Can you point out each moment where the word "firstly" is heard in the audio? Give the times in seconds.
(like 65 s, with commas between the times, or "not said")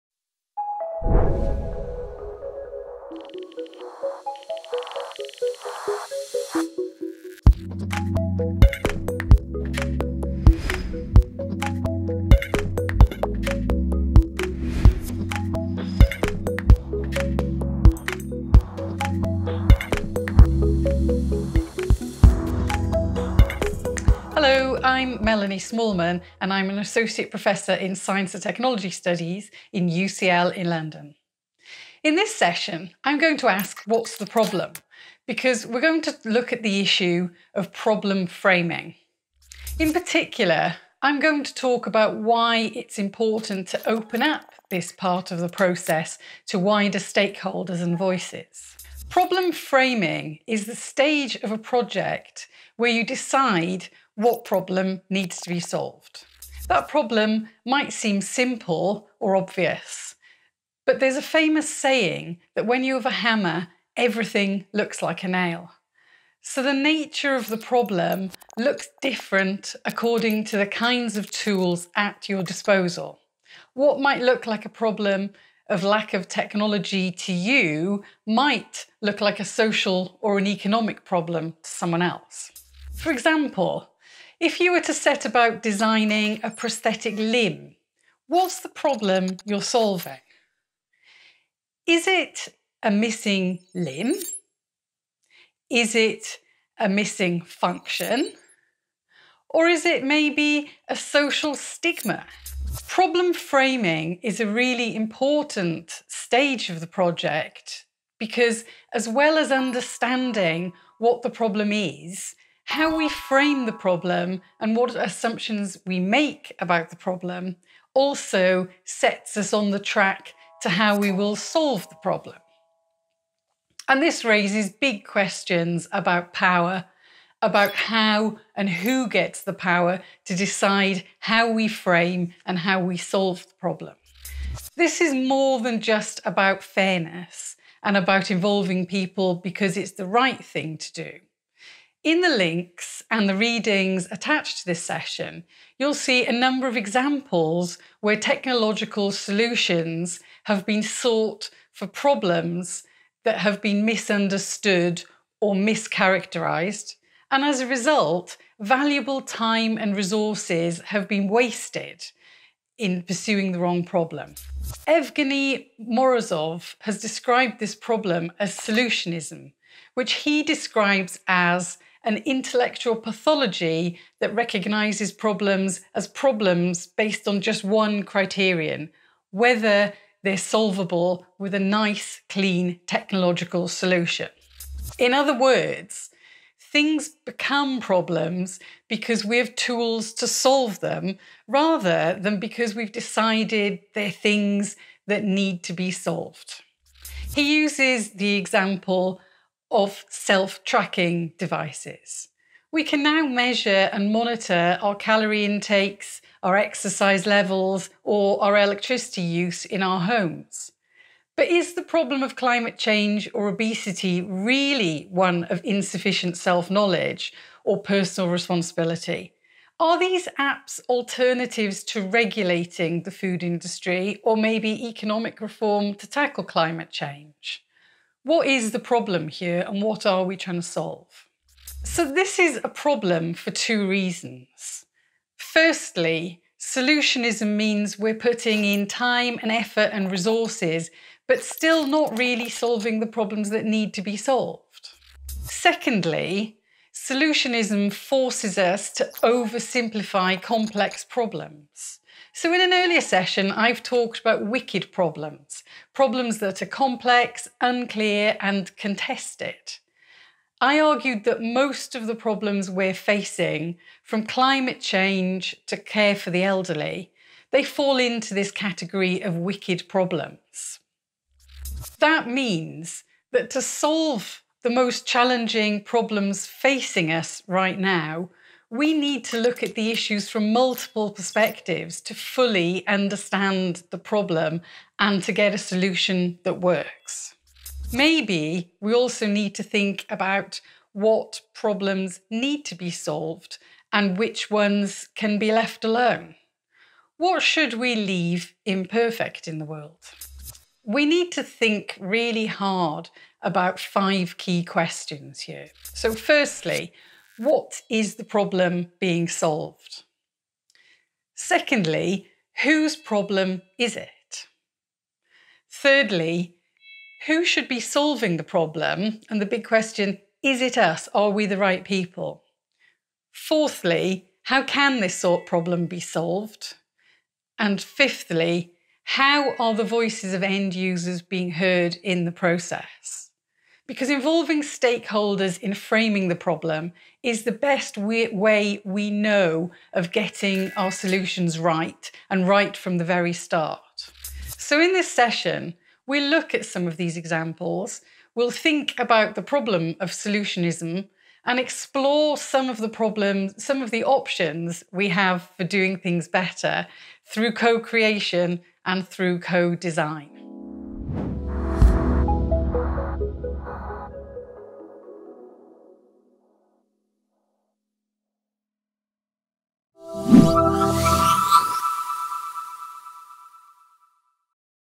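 235 s, 306 s.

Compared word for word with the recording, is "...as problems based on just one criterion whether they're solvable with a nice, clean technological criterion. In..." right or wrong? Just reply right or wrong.
wrong.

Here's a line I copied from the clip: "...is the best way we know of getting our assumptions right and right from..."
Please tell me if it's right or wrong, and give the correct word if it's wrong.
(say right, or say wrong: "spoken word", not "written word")
wrong: "solutions", not "assumptions".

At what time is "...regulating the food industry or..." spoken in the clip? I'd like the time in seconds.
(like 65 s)
222 s.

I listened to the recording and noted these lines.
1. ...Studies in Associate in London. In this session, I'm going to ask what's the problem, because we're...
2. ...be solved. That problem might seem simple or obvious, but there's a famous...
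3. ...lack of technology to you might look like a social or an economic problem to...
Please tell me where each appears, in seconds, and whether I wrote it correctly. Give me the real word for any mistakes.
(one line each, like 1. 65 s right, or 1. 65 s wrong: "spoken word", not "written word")
1. 28 s wrong: "UCL", not "Associate"
2. 55 s right
3. 75 s right.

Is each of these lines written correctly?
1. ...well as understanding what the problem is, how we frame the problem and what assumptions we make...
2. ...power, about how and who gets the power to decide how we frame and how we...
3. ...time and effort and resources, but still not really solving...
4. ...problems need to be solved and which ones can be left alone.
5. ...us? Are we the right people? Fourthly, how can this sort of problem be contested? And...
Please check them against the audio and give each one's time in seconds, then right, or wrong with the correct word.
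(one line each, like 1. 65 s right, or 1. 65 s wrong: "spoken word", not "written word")
1. 109 s right
2. 126 s right
3. 238 s right
4. 291 s right
5. 320 s wrong: "solved", not "contested".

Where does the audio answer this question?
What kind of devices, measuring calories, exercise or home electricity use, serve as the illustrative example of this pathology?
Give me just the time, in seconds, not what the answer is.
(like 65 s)
200 s.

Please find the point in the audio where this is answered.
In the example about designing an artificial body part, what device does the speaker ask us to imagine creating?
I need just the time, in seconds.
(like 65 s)
86 s.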